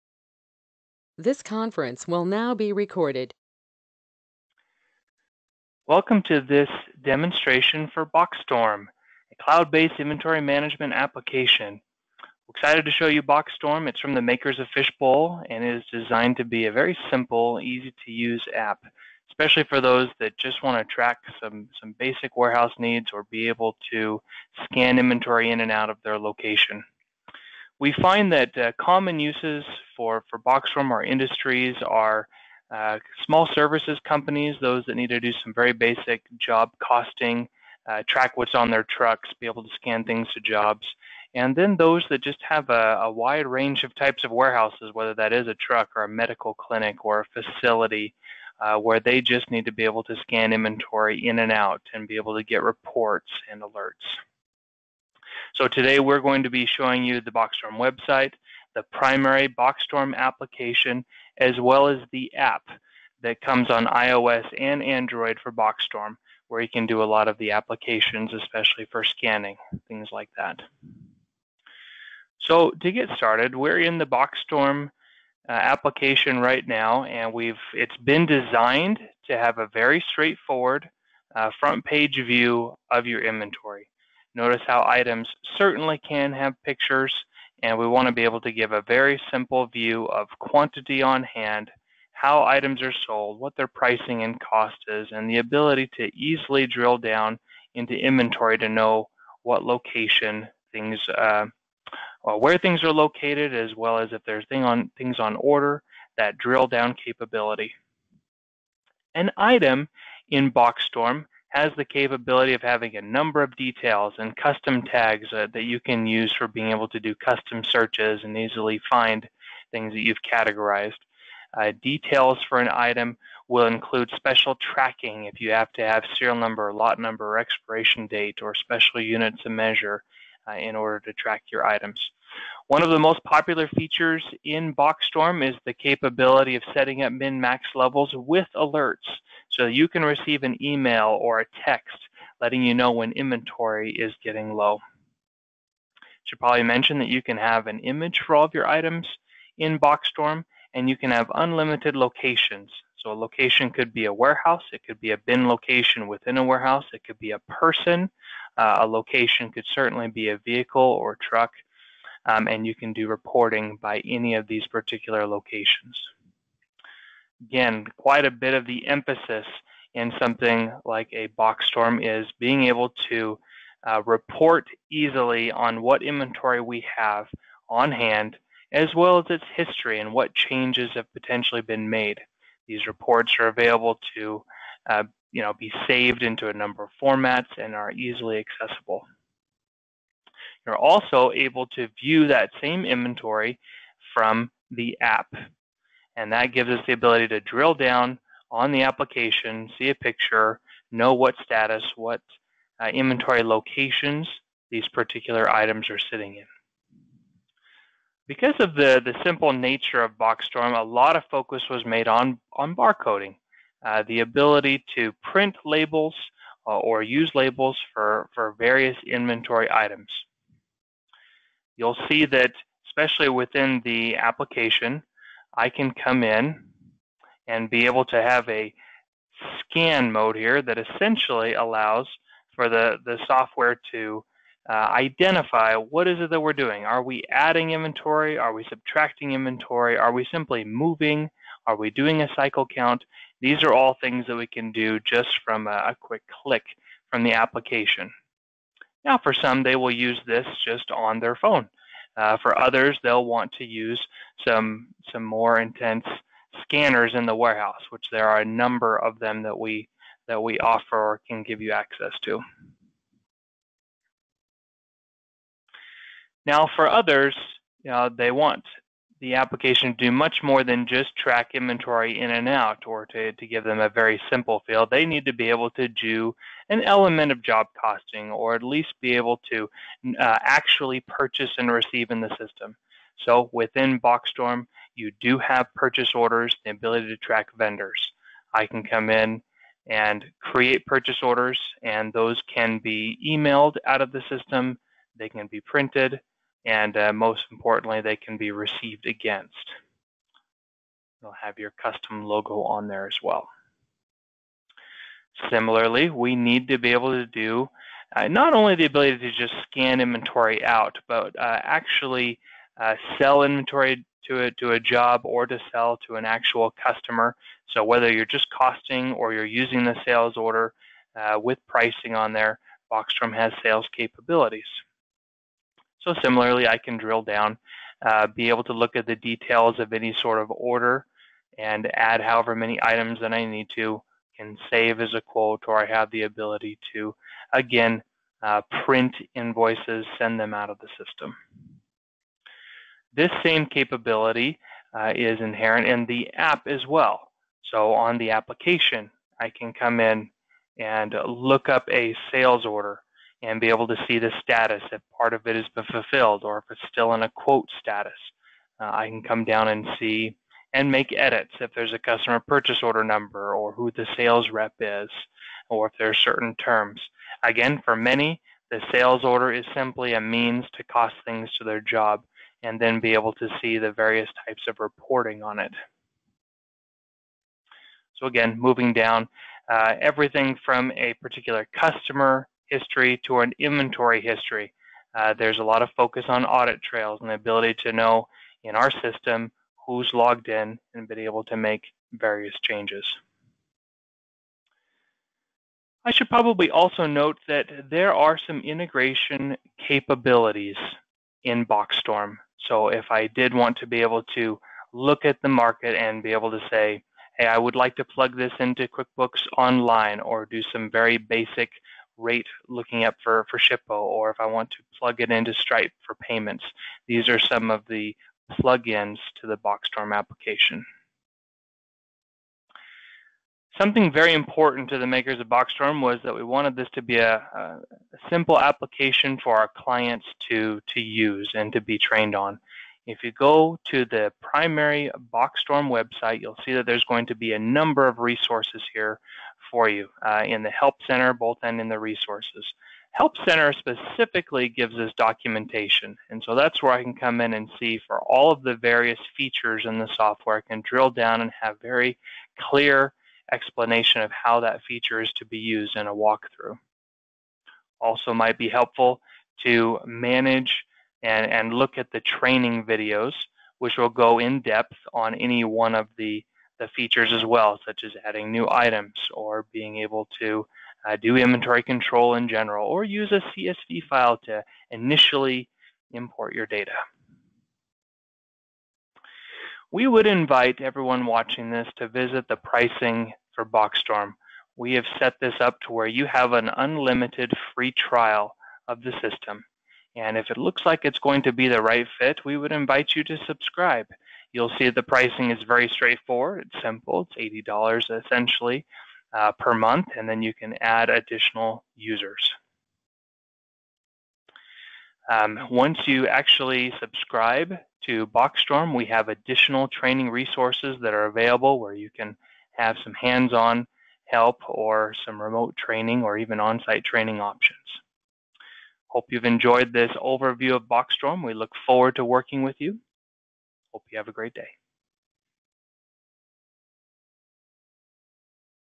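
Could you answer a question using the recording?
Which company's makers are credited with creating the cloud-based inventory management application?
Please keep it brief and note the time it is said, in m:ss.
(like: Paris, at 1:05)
Fishbowl, at 0:14.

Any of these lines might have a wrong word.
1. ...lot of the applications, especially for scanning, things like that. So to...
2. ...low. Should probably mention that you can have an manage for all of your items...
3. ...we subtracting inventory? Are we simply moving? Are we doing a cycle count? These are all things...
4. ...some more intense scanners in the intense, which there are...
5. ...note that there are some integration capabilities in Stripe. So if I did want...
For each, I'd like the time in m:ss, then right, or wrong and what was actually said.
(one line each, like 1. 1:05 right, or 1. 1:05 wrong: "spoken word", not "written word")
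1. 1:07 right
2. 2:24 wrong: "image", not "manage"
3. 3:58 right
4. 4:15 wrong: "warehouse", not "intense"
5. 6:37 wrong: "Boxstorm", not "Stripe".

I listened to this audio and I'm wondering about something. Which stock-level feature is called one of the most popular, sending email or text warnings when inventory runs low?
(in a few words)
min-max levels.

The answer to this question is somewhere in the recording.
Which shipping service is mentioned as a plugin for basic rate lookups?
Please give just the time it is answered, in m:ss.
6:53.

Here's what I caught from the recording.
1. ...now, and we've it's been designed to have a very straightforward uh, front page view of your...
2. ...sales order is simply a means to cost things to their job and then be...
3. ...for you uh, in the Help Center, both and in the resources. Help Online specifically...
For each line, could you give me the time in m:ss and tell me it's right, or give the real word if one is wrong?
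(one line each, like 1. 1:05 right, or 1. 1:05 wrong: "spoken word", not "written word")
1. 1:16 right
2. 6:08 right
3. 7:19 wrong: "Center", not "Online".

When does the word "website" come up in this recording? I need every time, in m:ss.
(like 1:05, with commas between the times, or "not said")
0:57, 7:15.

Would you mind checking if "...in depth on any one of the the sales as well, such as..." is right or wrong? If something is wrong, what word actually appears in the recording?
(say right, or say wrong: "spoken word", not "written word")
wrong: "features", not "sales".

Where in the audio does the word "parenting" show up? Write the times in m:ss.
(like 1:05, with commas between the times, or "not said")
not said.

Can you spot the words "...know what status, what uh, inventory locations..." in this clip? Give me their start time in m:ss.
3:20.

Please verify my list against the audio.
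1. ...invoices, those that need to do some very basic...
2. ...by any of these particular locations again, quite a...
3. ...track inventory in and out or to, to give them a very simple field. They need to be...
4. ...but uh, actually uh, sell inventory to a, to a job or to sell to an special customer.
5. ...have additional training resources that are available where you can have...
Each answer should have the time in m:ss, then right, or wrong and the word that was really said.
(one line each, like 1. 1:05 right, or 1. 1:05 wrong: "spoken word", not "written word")
1. 0:34 wrong: "companies", not "invoices"
2. 2:43 right
3. 4:31 right
4. 5:11 wrong: "actual", not "special"
5. 8:29 right.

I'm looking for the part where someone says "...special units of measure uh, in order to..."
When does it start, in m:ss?
2:08.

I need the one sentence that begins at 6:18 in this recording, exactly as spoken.
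So again, moving down, uh, everything from a particular customer history to an inventory history.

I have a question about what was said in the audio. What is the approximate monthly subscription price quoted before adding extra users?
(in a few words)
$80.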